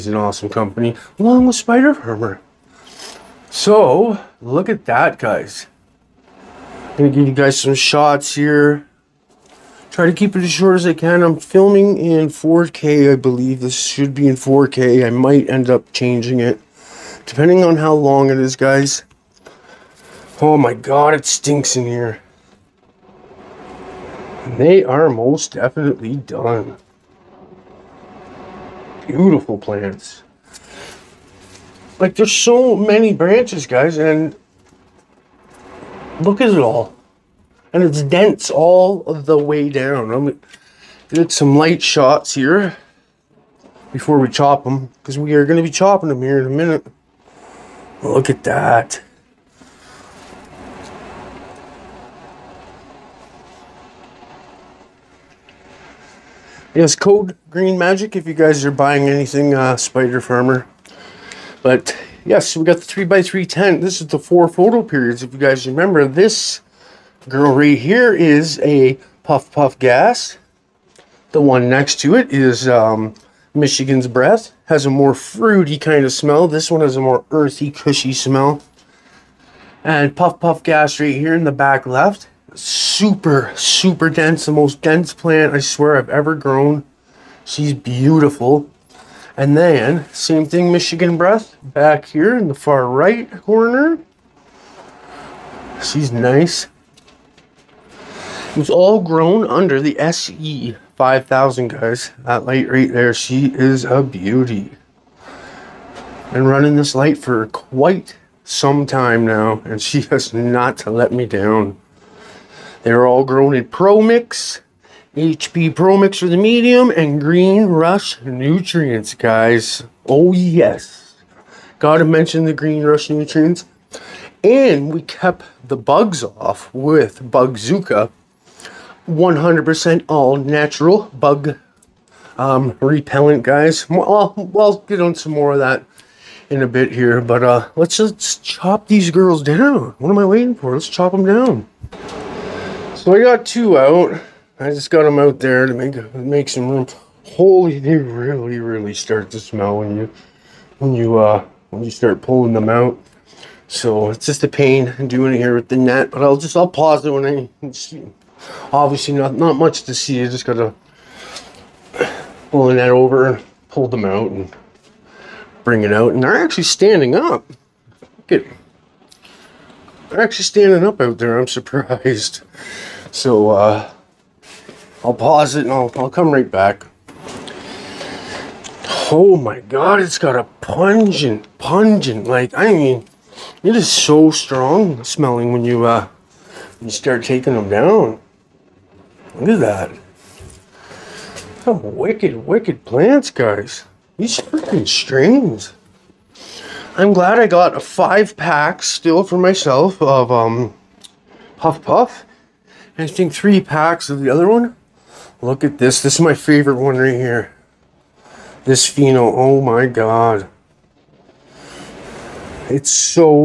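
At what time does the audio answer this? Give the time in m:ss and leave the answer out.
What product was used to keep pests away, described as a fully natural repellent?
2:07.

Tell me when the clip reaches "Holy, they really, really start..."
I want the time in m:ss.
2:27.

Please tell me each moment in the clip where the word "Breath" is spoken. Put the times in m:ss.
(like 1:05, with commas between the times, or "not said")
1:14, 1:31.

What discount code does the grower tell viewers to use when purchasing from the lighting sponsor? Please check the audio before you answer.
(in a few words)
Green Magic.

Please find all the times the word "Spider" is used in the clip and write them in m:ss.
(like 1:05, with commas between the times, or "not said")
0:01, 0:59.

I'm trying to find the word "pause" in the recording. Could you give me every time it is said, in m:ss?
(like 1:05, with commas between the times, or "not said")
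2:36, 2:55.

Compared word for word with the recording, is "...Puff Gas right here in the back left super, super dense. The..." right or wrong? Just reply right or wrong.
right.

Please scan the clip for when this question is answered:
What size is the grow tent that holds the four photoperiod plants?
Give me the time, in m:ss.
1:02.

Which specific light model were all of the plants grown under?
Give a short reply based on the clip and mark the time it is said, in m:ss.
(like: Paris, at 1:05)
SE 5000, at 1:39.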